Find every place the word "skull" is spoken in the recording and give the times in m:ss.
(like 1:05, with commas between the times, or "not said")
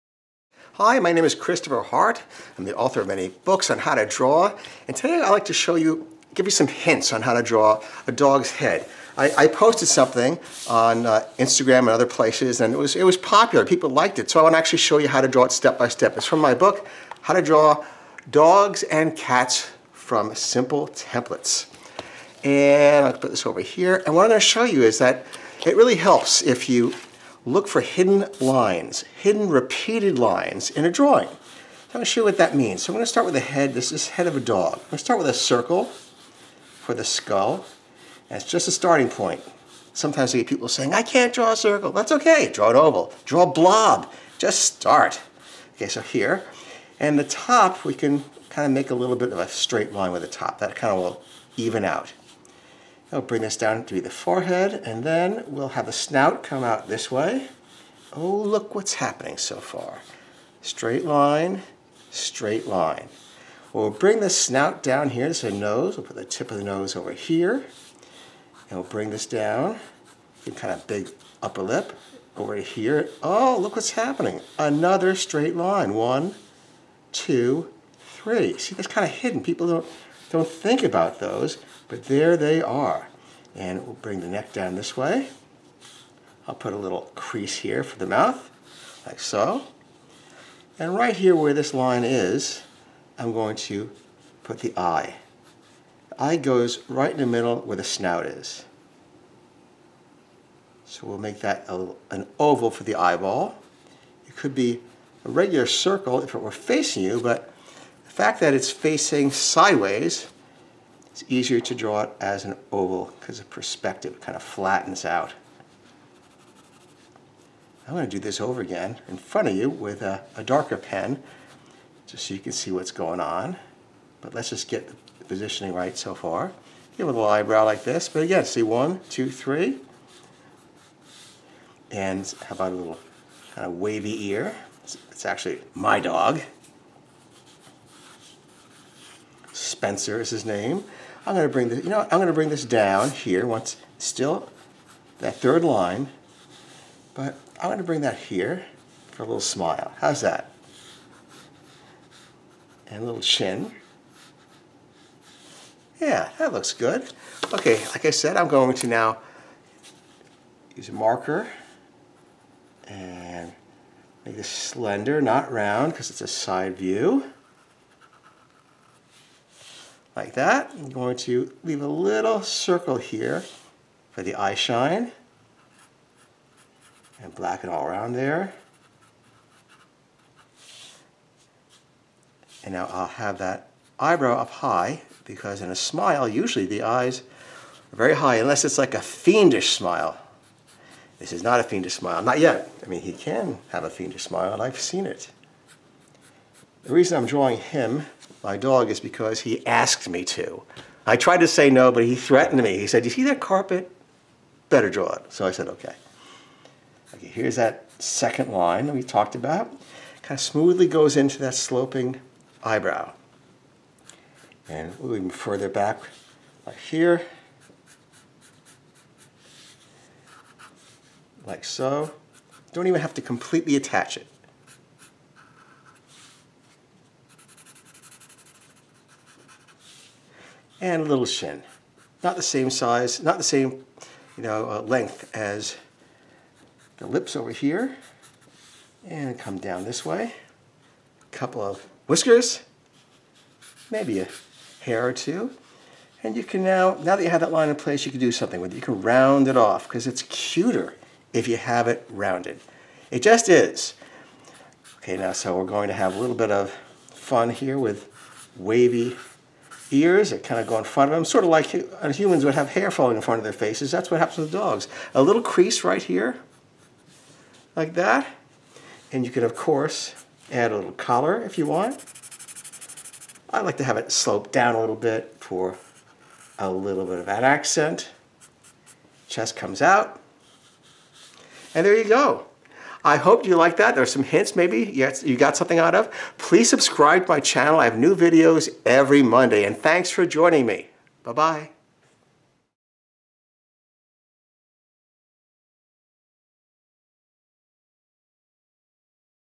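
0:37.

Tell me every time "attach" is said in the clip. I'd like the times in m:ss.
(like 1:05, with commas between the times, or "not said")
3:43.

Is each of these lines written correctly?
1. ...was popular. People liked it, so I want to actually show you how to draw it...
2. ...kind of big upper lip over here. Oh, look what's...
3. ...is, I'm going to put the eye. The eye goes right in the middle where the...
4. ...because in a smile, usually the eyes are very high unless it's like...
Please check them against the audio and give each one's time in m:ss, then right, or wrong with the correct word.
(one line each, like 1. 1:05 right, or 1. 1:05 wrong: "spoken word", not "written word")
1. 0:13 right
2. 1:10 right
3. 1:32 right
4. 3:05 right.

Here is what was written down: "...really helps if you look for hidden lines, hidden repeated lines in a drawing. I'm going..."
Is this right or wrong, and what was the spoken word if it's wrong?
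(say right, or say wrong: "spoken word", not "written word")
right.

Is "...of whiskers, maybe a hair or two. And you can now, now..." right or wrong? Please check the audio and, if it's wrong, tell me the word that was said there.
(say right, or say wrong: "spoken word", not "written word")
right.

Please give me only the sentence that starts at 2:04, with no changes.
But let's just get the positioning right so far.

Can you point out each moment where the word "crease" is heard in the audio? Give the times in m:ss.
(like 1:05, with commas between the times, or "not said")
1:27, 4:25.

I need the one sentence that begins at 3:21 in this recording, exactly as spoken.
I tried to say no, but he threatened me.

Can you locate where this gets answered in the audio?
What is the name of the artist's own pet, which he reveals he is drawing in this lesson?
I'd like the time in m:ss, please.
2:19.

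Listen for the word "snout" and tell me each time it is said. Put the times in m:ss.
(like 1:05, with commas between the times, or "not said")
0:55, 1:04, 1:37.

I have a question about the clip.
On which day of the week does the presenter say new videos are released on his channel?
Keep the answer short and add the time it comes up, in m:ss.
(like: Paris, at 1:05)
Monday, at 4:49.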